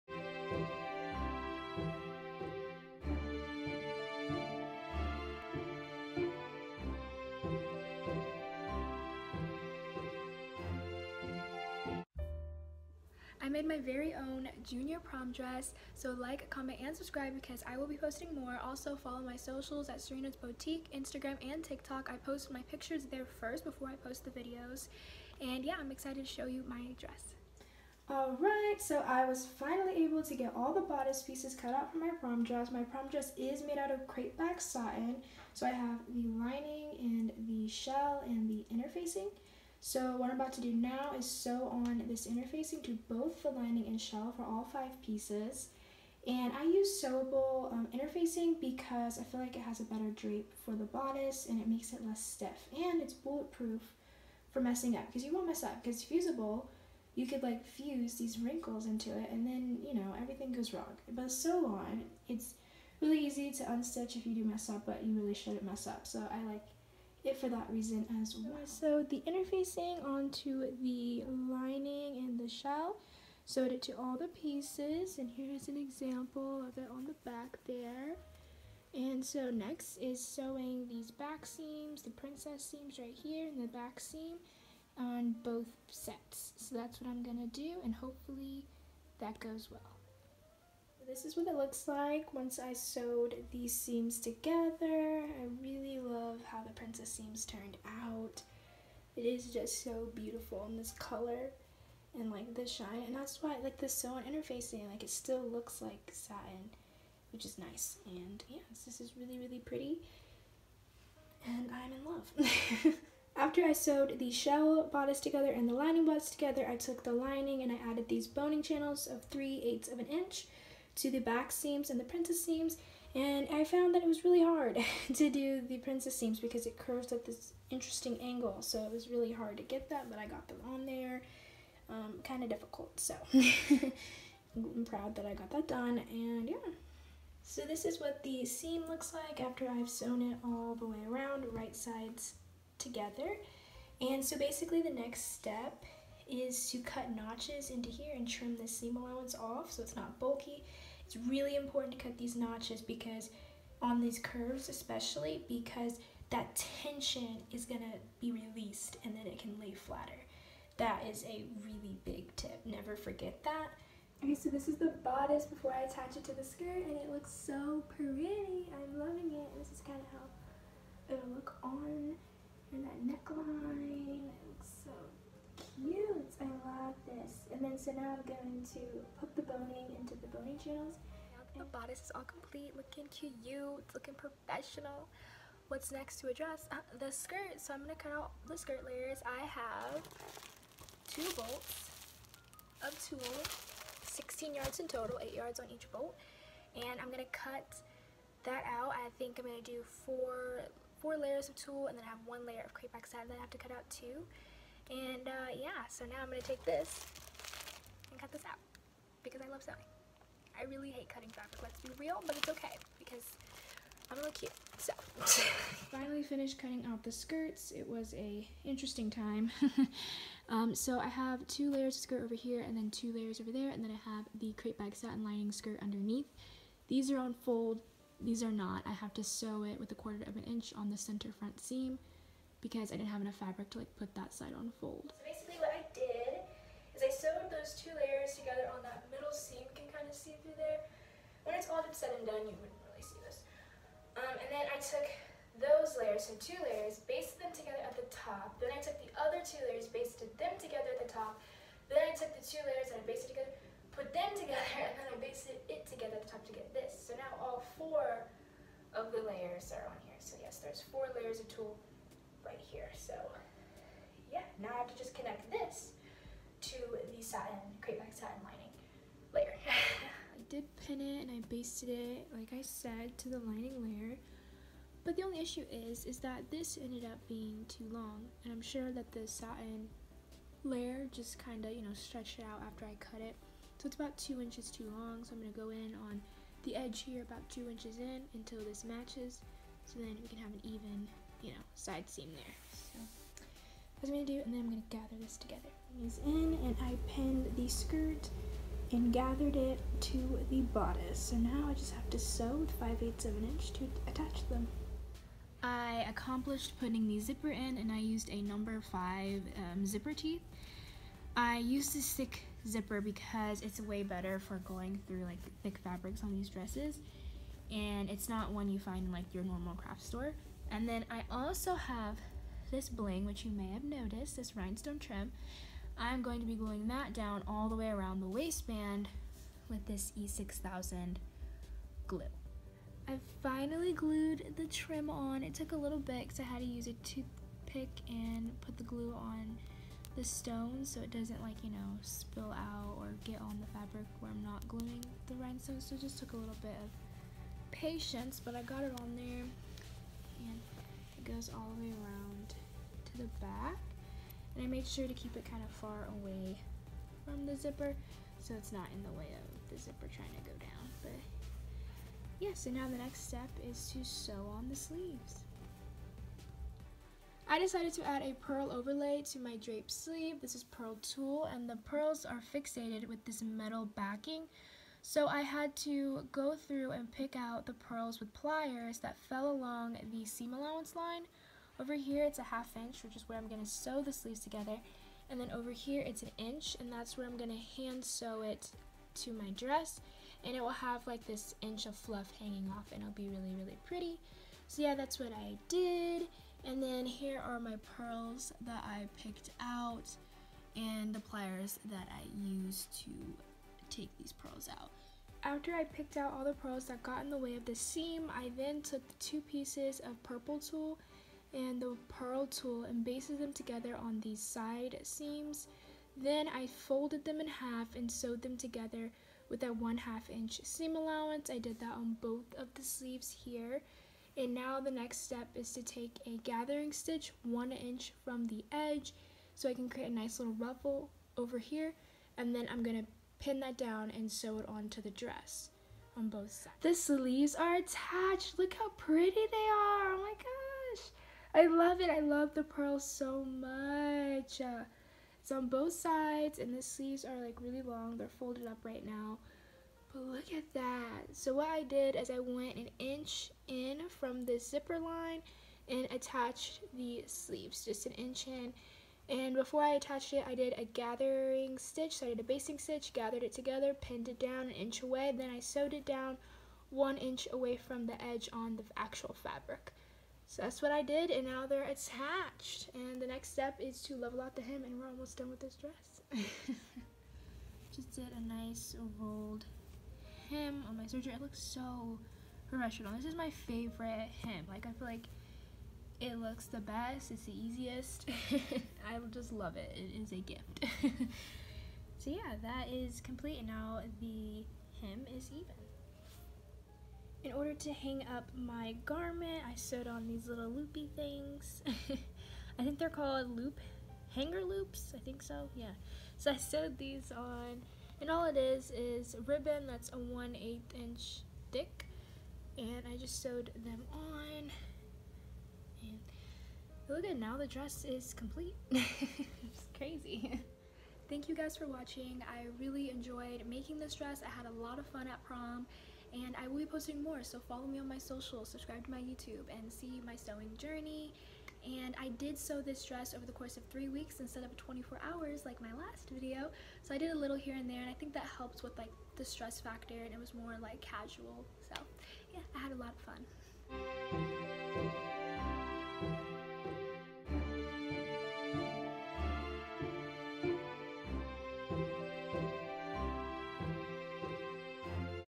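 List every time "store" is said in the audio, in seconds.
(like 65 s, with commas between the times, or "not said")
320 s.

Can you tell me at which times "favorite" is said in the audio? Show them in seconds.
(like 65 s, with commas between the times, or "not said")
483 s.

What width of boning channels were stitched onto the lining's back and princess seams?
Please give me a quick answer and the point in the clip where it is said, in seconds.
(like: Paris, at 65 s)
3/8 inch, at 119 s.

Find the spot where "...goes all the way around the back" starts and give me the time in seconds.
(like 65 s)
351 s.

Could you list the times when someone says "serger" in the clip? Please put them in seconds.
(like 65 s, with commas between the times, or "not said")
481 s.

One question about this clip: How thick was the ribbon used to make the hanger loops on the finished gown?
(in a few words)
1/8 inch.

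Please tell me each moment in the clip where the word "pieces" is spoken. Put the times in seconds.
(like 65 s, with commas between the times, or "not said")
31 s, 45 s, 74 s, 409 s.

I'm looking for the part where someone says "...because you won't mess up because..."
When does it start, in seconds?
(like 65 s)
55 s.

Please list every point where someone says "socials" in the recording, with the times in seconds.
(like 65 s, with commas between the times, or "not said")
19 s, 528 s.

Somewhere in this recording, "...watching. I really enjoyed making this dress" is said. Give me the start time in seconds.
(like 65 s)
521 s.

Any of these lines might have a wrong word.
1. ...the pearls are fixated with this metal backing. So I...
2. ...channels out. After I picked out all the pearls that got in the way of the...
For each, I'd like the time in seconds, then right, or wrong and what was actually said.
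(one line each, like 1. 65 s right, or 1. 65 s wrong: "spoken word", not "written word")
1. 371 s right
2. 404 s wrong: "pearls", not "channels".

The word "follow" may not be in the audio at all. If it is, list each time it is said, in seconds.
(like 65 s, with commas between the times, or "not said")
18 s, 527 s.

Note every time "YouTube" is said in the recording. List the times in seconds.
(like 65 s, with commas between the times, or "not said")
529 s.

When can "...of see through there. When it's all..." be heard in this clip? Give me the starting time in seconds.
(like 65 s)
240 s.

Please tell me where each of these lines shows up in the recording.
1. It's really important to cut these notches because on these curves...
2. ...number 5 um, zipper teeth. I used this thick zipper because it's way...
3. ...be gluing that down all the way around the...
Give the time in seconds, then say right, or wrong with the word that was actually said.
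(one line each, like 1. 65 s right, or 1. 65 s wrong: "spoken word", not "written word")
1. 151 s right
2. 308 s right
3. 326 s right.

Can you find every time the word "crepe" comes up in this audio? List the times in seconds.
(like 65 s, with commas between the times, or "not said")
34 s, 202 s, 224 s, 267 s.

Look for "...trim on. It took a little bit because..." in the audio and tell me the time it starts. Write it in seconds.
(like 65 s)
334 s.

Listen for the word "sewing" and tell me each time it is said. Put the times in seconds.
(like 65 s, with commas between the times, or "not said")
80 s, 209 s, 530 s.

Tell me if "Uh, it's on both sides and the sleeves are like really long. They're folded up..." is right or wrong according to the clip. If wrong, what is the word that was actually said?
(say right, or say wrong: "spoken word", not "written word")
right.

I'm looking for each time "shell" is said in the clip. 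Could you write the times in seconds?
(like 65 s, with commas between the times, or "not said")
37 s, 43 s, 72 s, 114 s.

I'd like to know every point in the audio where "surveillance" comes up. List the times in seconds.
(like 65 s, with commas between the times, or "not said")
not said.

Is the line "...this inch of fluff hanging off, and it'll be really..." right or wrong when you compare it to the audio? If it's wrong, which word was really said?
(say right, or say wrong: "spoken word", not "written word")
right.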